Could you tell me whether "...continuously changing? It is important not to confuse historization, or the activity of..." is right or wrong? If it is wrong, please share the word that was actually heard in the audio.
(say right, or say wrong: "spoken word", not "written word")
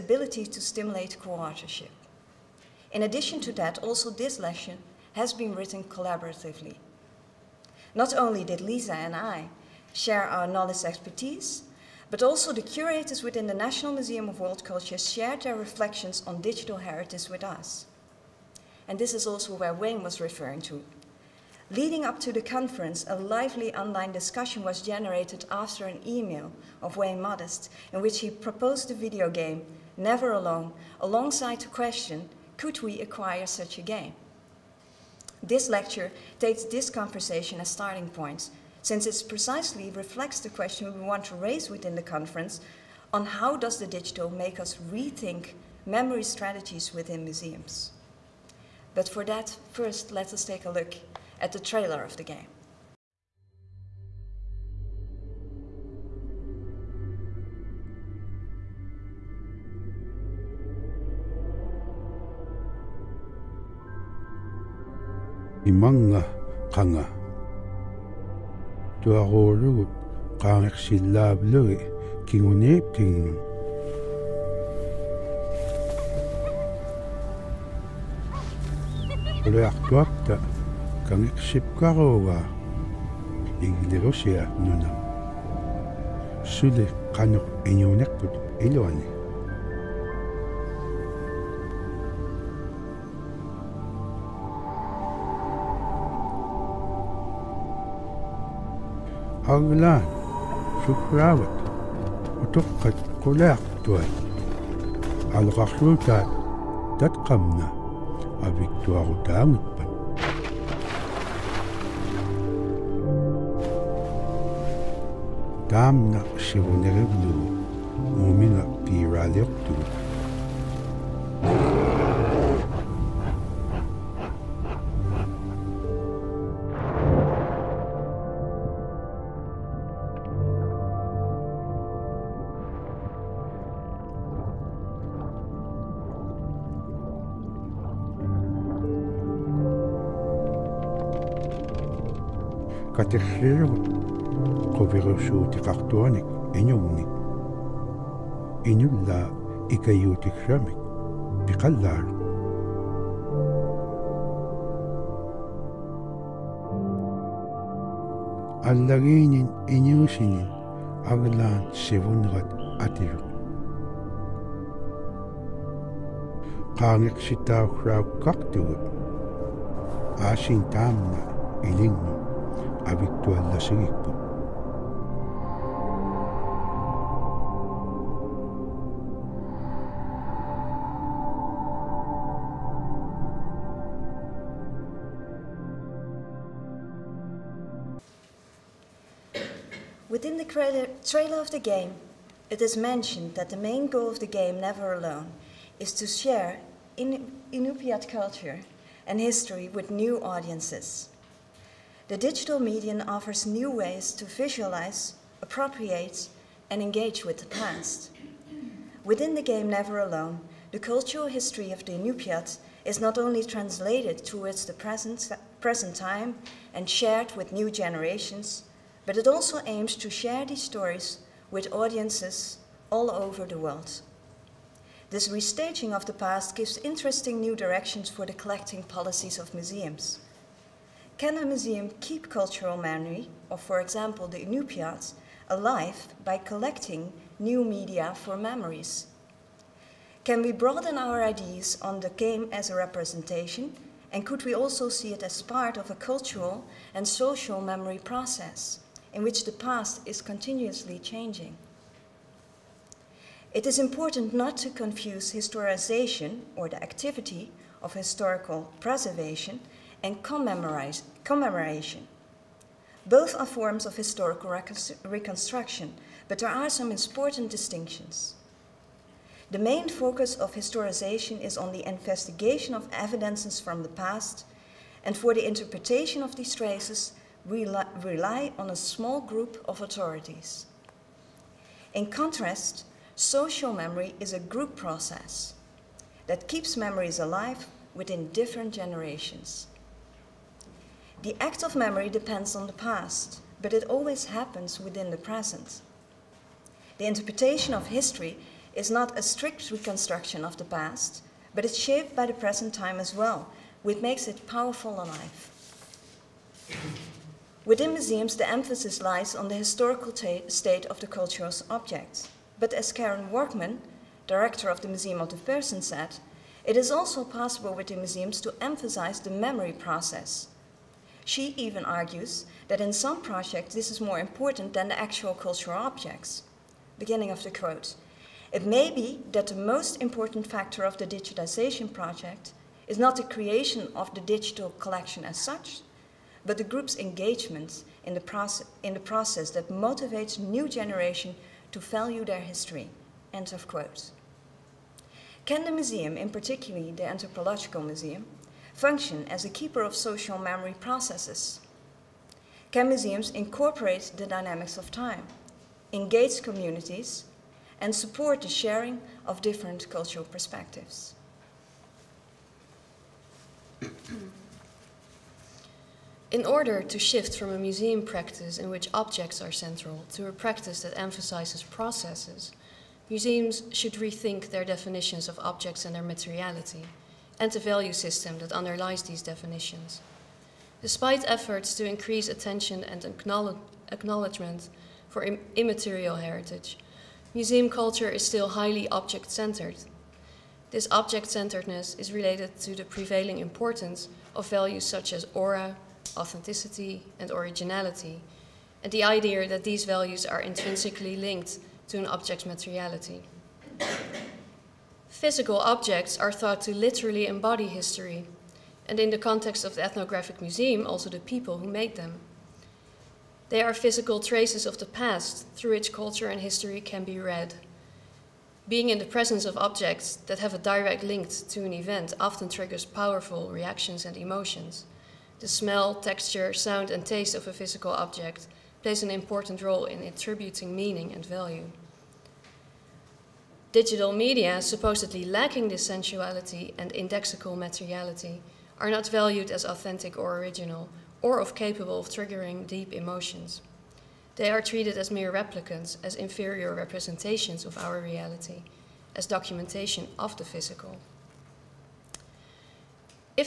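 right.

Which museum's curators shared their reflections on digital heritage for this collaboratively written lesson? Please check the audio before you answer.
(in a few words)
National Museum of World Culture.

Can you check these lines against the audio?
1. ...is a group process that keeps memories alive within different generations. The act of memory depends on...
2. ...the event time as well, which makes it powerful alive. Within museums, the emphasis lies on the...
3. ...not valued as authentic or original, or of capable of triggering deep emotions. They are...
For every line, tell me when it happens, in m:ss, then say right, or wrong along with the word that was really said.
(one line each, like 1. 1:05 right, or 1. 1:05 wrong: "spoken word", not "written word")
1. 4:44 right
2. 5:02 wrong: "present", not "event"
3. 7:18 right.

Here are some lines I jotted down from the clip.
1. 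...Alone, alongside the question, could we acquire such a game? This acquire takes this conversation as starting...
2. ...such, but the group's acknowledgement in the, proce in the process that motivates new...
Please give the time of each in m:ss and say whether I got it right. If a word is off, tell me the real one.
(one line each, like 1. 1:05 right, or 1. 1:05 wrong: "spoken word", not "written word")
1. 0:30 wrong: "lecture", not "acquire"
2. 5:35 wrong: "engagement", not "acknowledgement".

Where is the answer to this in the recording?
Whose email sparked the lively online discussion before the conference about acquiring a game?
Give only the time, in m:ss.
0:26.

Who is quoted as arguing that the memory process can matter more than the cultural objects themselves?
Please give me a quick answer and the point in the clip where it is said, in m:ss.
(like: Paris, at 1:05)
Karen Worcman, at 5:12.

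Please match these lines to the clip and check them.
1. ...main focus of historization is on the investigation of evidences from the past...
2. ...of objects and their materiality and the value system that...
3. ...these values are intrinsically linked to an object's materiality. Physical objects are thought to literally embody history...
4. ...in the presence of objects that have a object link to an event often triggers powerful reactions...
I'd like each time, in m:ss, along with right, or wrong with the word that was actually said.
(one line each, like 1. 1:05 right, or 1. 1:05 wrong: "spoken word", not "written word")
1. 4:29 right
2. 6:15 right
3. 6:39 right
4. 6:58 wrong: "direct", not "object".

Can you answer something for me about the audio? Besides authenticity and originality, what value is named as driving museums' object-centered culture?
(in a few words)
aura.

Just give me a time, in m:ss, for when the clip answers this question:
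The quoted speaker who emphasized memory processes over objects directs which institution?
5:14.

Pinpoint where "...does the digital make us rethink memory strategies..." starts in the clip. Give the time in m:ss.
0:43.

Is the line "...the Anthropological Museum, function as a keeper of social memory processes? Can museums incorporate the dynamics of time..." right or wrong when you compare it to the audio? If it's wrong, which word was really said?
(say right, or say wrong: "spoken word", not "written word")
right.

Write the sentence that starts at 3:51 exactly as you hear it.
Can a museum keep cultural memory, or for example the Inupiats, alive by collecting new media for memories?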